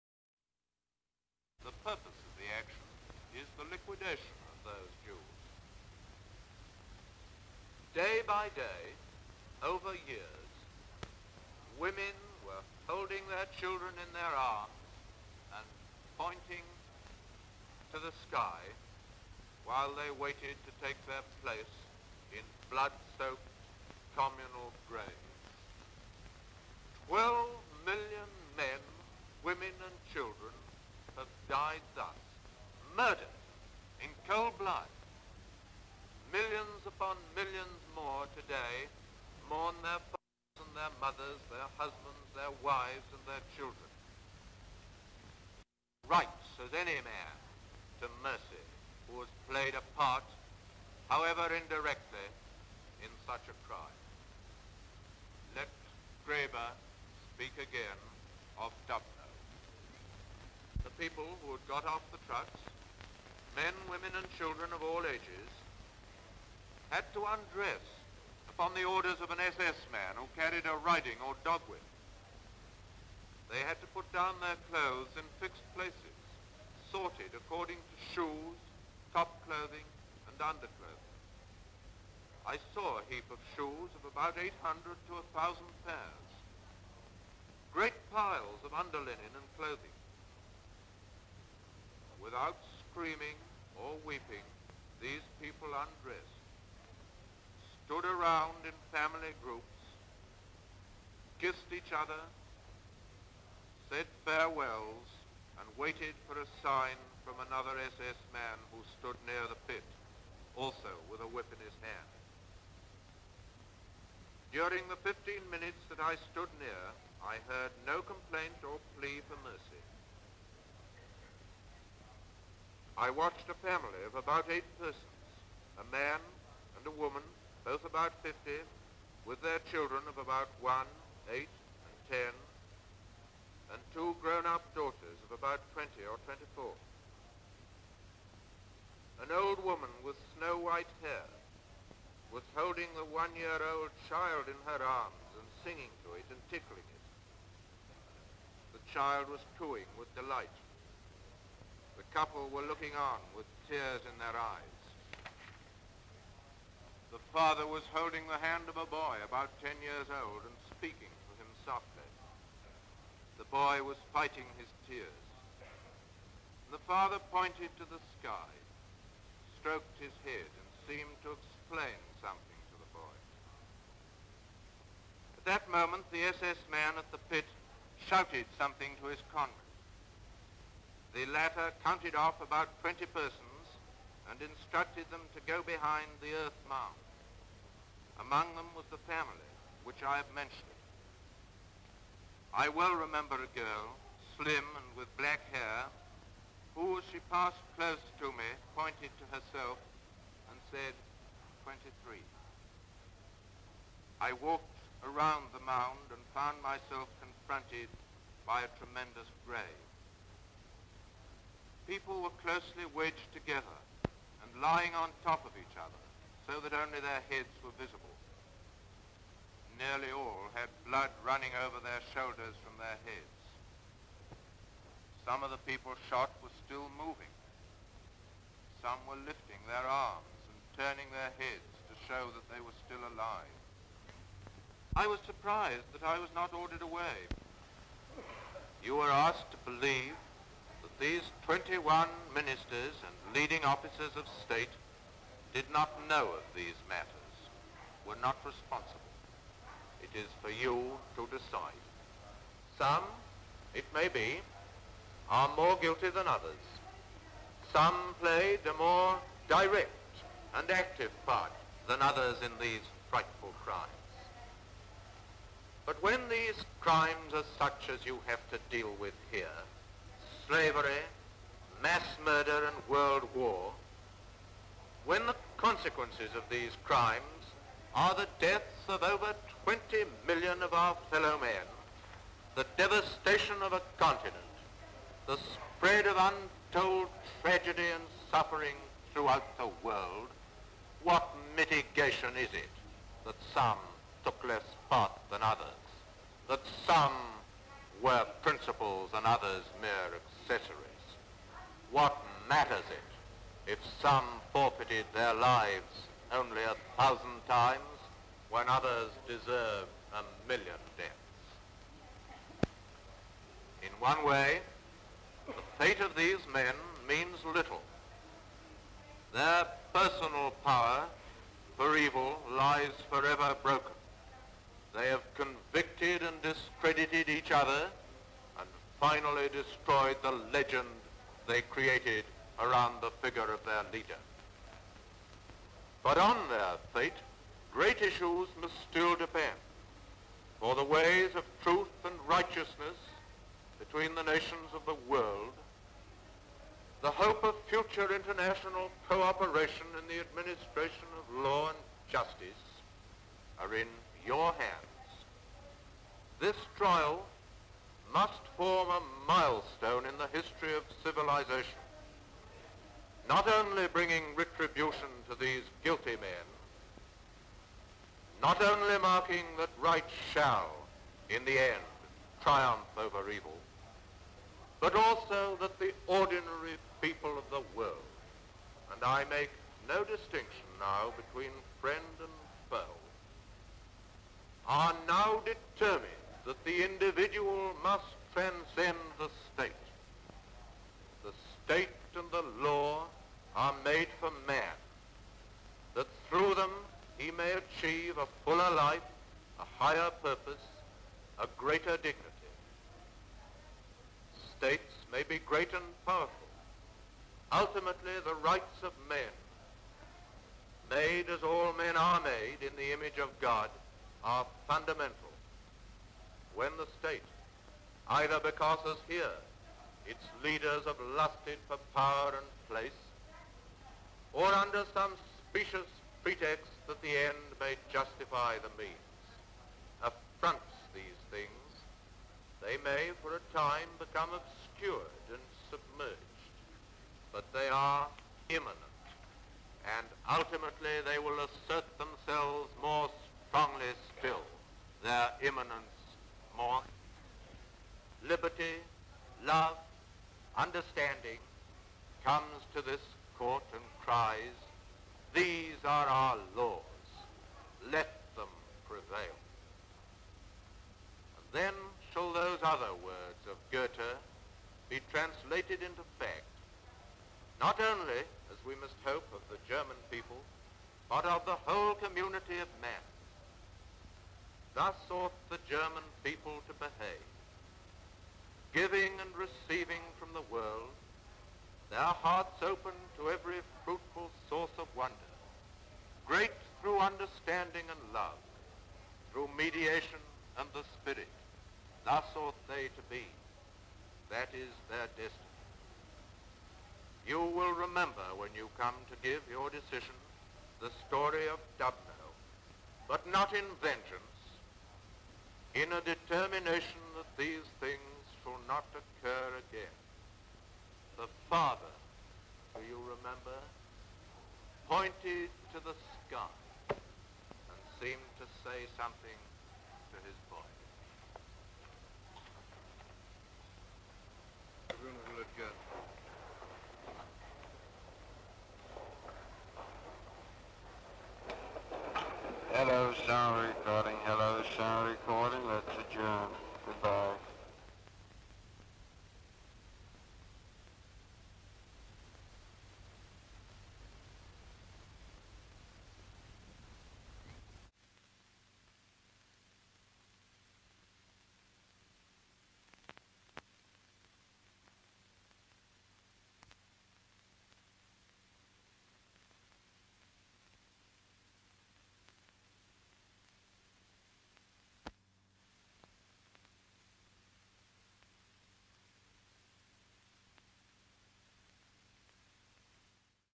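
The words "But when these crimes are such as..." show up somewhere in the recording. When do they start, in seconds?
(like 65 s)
265 s.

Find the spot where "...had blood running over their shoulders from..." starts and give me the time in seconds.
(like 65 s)
220 s.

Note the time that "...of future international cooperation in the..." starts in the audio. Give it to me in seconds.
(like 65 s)
347 s.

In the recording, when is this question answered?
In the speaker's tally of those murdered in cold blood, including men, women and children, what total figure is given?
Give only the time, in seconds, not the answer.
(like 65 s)
27 s.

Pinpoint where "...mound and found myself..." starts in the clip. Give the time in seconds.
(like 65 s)
205 s.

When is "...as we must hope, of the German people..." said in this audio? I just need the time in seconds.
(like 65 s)
468 s.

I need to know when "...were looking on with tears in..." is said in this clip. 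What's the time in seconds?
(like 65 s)
152 s.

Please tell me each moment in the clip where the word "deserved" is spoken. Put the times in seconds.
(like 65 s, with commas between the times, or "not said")
309 s.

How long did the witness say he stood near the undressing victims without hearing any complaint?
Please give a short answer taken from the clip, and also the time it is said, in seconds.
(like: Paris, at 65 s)
15 minutes, at 115 s.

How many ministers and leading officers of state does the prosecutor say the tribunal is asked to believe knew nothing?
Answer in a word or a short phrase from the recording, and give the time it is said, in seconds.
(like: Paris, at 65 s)
21, at 241 s.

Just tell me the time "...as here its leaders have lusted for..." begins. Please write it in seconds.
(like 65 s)
418 s.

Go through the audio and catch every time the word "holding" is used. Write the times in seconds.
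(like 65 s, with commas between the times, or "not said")
12 s, 142 s, 157 s.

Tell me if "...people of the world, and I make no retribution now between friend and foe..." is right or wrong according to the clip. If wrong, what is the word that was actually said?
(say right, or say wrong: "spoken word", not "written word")
wrong: "distinction", not "retribution".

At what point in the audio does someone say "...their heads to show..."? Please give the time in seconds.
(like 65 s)
231 s.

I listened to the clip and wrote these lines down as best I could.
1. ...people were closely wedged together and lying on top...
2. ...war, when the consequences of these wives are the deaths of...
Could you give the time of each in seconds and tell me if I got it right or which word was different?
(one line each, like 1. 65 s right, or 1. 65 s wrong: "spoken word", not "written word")
1. 211 s right
2. 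273 s wrong: "crimes", not "wives".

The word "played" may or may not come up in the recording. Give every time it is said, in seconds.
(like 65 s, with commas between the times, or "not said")
49 s, 258 s.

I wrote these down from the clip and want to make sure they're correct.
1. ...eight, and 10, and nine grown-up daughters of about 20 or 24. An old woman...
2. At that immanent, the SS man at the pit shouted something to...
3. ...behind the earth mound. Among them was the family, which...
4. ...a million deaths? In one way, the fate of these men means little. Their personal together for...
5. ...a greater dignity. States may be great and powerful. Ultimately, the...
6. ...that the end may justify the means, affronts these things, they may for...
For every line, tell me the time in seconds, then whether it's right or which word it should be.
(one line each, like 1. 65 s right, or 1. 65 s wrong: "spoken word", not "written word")
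1. 131 s wrong: "two", not "nine"
2. 175 s wrong: "moment", not "immanent"
3. 185 s right
4. 310 s wrong: "power", not "together"
5. 401 s right
6. 426 s right.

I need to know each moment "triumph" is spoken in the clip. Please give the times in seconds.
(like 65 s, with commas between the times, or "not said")
372 s.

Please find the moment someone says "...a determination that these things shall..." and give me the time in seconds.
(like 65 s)
505 s.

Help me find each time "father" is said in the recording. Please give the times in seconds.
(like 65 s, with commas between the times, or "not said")
40 s, 157 s, 166 s, 511 s.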